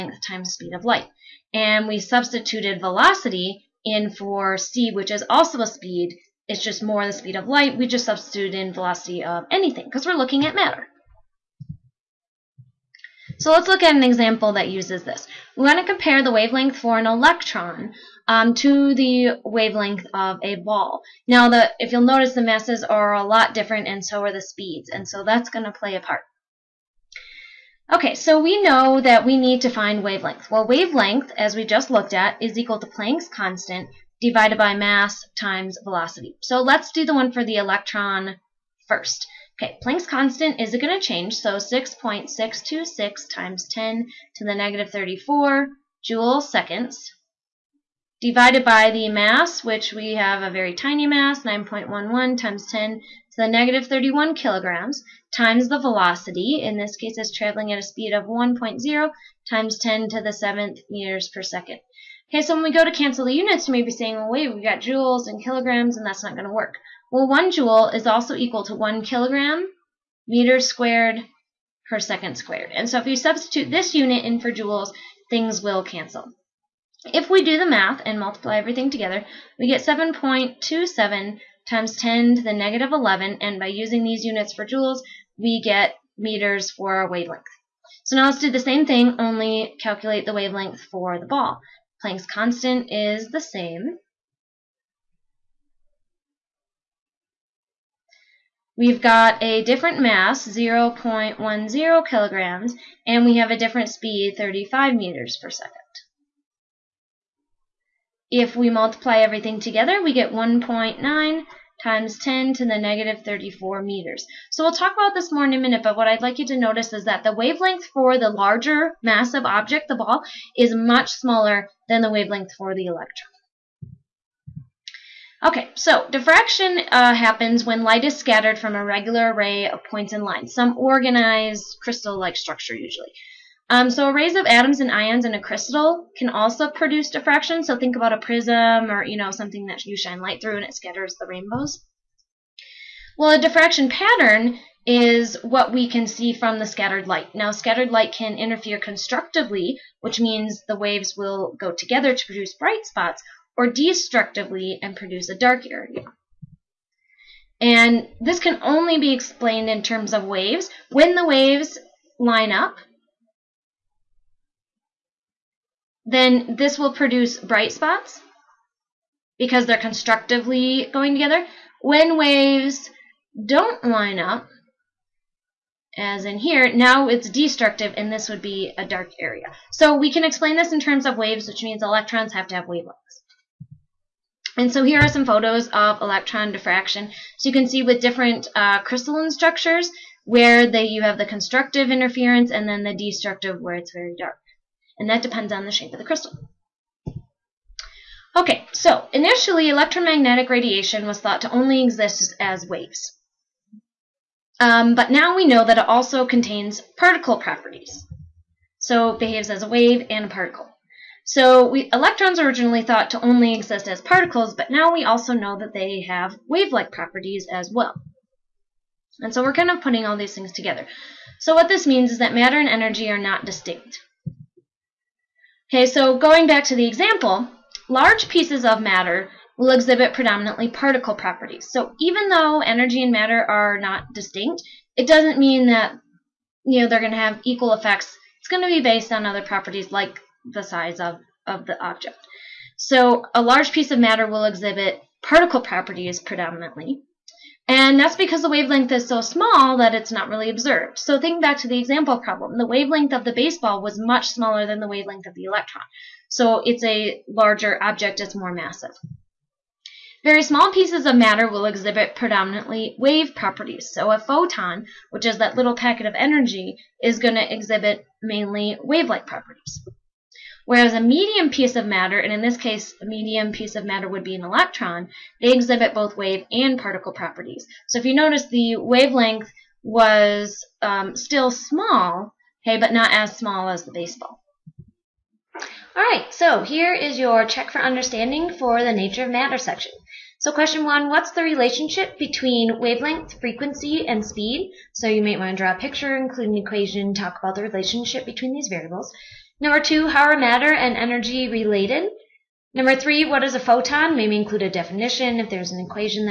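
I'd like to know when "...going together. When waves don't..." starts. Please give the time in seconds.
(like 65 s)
170 s.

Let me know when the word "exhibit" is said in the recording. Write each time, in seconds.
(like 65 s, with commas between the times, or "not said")
229 s, 244 s, 261 s, 267 s, 275 s.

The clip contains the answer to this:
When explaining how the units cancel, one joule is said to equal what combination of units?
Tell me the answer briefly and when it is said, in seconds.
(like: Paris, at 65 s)
kilogram meters squared per second squared, at 68 s.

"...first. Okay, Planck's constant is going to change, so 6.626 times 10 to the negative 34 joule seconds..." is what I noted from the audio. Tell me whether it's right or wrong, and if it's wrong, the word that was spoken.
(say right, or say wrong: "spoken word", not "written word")
right.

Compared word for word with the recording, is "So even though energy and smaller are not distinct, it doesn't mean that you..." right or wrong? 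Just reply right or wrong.
wrong.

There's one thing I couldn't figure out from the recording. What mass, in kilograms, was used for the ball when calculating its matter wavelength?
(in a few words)
0.10 kilograms.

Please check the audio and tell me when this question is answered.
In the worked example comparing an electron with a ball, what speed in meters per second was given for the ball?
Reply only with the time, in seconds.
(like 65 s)
104 s.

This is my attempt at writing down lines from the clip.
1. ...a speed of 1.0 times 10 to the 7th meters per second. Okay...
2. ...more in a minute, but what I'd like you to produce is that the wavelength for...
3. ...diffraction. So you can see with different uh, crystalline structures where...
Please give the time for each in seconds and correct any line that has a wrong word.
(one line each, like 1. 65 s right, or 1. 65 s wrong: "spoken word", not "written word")
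1. 57 s right
2. 115 s wrong: "notice", not "produce"
3. 186 s right.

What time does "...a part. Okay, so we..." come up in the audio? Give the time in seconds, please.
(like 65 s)
25 s.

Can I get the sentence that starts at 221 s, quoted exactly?
So what this means is that matter and energy are not distinct.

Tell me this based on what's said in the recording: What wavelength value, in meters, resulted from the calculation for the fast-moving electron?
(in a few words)
7.27 times 10^-11.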